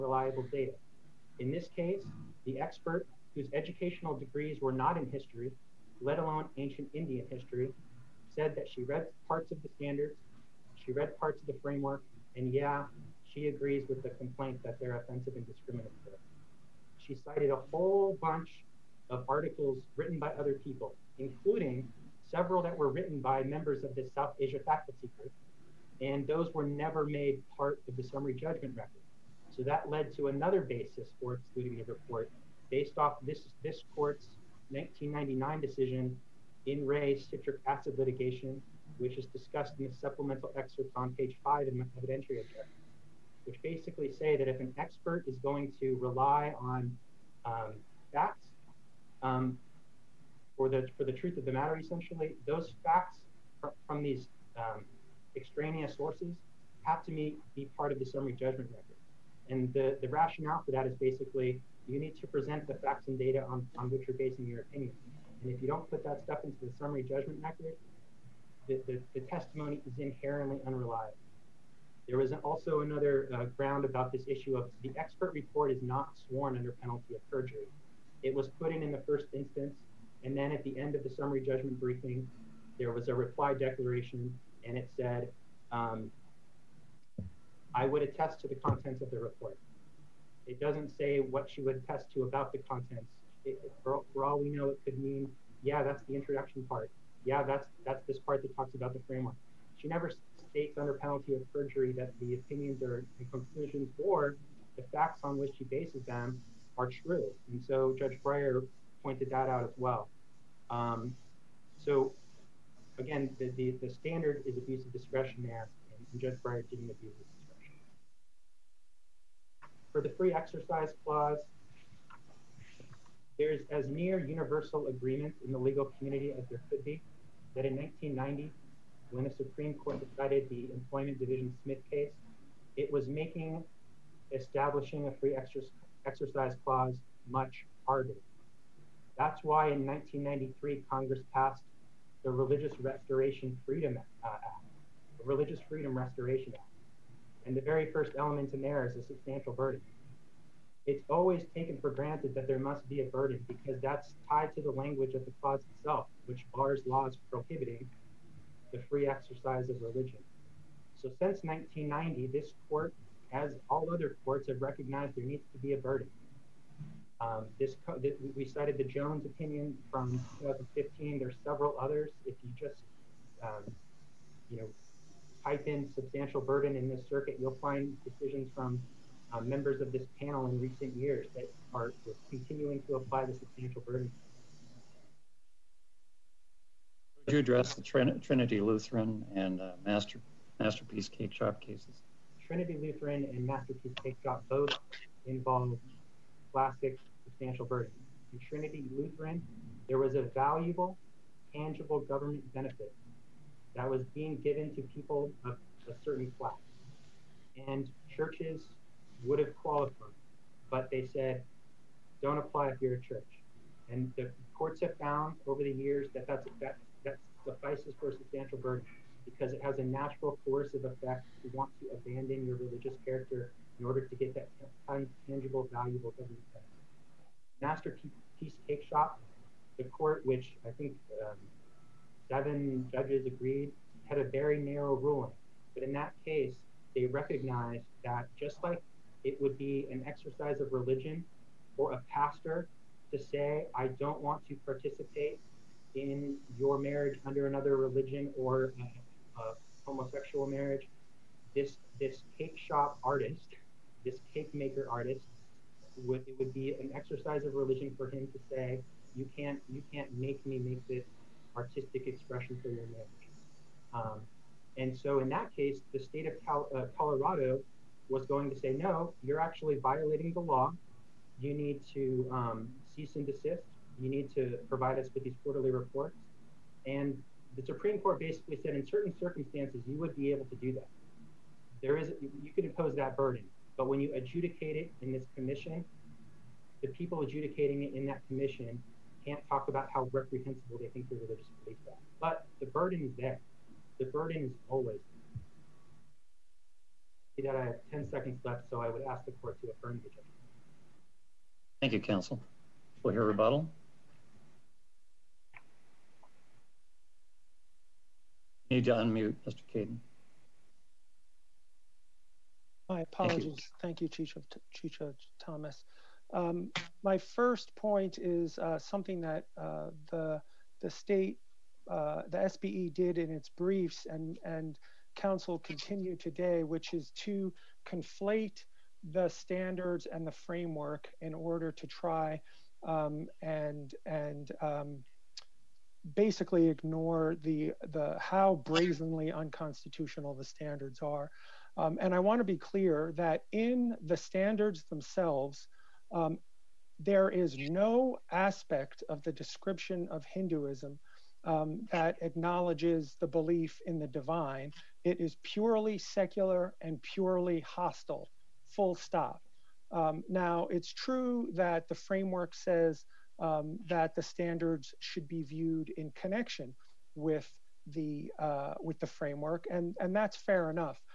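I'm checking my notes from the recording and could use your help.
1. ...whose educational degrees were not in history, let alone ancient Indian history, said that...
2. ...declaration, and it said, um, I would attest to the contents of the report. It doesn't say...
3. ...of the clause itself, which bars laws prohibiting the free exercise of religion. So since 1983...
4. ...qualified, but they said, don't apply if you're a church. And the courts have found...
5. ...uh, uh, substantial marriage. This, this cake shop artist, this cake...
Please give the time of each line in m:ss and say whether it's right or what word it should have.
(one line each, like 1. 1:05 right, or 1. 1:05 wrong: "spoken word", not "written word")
1. 0:03 right
2. 1:23 right
3. 2:35 wrong: "1990", not "1983"
4. 3:29 right
5. 4:09 wrong: "homosexual", not "substantial".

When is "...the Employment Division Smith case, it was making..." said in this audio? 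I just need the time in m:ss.
2:10.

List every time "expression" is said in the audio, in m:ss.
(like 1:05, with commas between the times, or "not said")
4:22.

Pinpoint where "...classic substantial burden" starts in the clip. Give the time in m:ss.
3:16.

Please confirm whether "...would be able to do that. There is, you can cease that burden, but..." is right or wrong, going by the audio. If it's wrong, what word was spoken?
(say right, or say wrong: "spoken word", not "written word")
wrong: "impose", not "cease".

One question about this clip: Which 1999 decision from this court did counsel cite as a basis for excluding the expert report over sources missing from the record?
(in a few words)
In re Citric Acid Litigation.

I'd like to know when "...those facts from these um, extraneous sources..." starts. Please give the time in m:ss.
0:52.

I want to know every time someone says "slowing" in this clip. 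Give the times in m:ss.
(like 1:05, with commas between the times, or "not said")
not said.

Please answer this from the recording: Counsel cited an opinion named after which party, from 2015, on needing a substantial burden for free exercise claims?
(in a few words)
Jones.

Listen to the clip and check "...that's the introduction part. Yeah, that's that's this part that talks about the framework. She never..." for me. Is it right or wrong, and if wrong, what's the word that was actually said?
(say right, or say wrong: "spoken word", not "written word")
right.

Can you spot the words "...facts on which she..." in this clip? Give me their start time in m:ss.
1:44.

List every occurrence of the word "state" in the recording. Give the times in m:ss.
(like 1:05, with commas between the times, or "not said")
1:40, 4:25, 5:20.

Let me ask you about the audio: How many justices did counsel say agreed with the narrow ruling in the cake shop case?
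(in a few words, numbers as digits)
7.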